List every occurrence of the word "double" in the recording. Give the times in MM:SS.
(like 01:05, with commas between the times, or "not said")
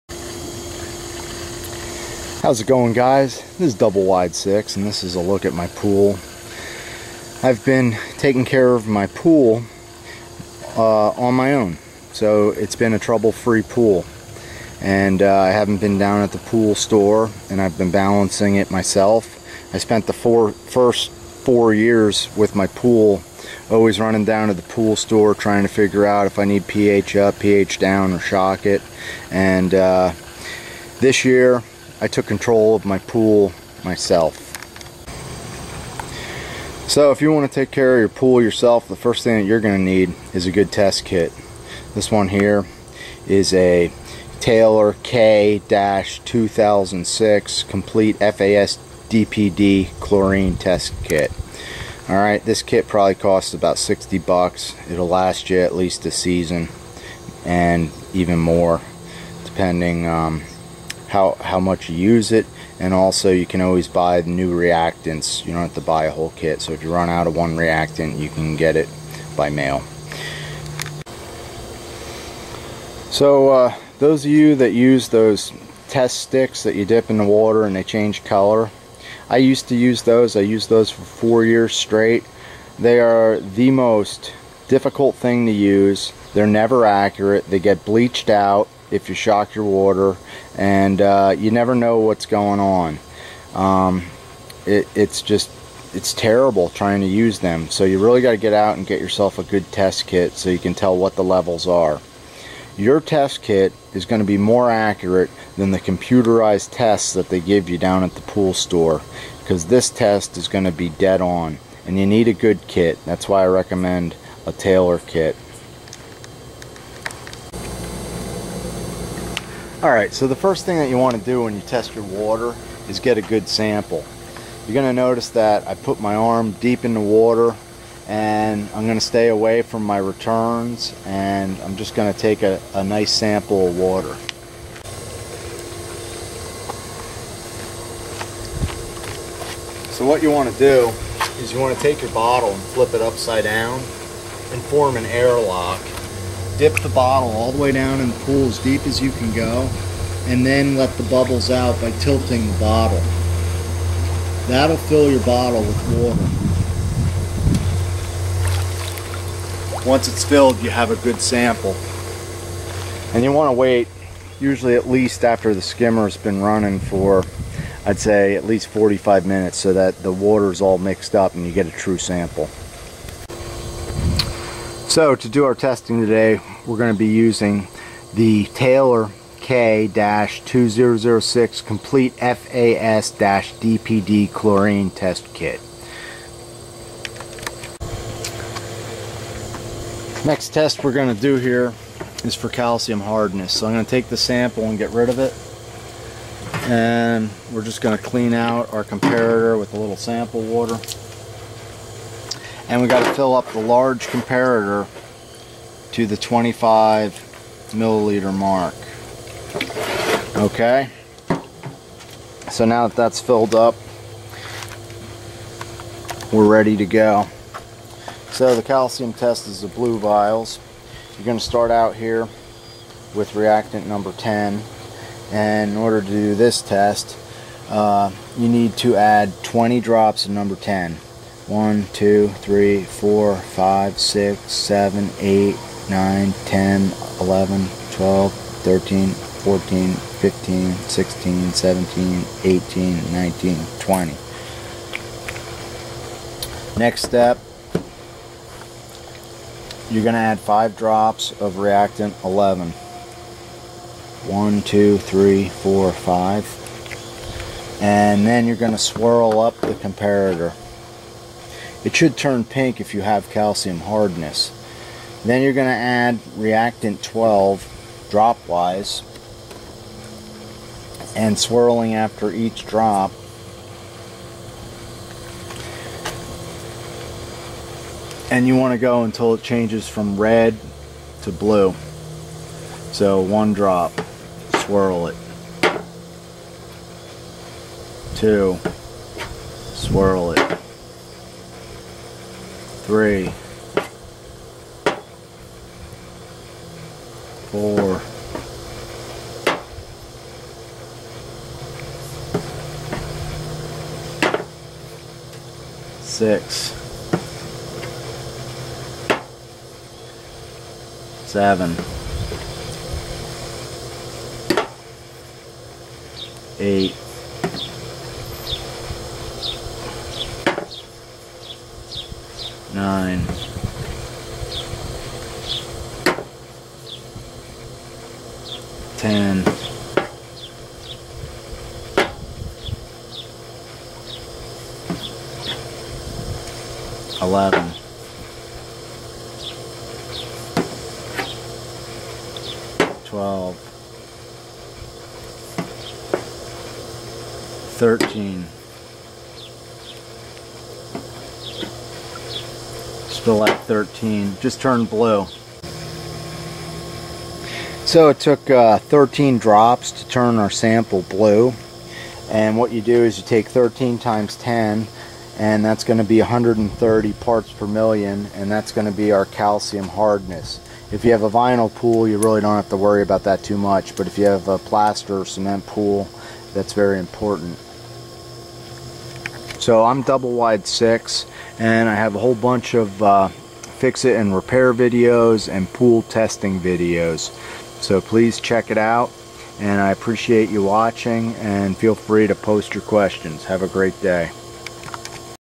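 00:03, 06:20.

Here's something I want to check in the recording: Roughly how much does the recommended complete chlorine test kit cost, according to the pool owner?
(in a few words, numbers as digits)
$60.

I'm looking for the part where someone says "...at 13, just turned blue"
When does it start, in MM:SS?
05:53.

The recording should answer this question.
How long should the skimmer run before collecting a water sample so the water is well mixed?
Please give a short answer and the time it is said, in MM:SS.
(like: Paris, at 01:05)
45 minutes, at 02:48.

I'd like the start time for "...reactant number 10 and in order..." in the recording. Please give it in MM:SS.
03:43.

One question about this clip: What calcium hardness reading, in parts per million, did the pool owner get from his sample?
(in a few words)
130.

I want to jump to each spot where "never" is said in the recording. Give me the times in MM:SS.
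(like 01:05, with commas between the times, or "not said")
01:26, 01:31.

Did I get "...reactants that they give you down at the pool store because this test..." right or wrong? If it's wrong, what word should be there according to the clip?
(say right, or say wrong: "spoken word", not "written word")
wrong: "tests", not "reactants".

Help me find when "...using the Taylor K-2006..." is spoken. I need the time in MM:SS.
02:57.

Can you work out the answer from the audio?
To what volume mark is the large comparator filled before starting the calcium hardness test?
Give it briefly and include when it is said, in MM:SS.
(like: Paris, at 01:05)
25 milliliters, at 03:26.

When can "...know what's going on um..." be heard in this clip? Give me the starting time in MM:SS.
01:31.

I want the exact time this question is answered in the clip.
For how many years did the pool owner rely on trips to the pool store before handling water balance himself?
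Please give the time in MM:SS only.
00:20.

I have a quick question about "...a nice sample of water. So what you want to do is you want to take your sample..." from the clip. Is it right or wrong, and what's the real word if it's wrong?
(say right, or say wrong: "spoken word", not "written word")
wrong: "bottle", not "sample".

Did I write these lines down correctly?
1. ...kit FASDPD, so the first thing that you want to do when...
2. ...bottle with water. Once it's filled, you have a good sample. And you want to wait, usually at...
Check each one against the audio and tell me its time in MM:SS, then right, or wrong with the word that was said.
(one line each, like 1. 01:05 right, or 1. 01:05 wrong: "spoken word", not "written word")
1. 01:54 wrong: "Alright", not "FASDPD"
2. 02:35 right.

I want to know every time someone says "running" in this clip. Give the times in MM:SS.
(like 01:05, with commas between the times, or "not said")
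00:23, 02:46.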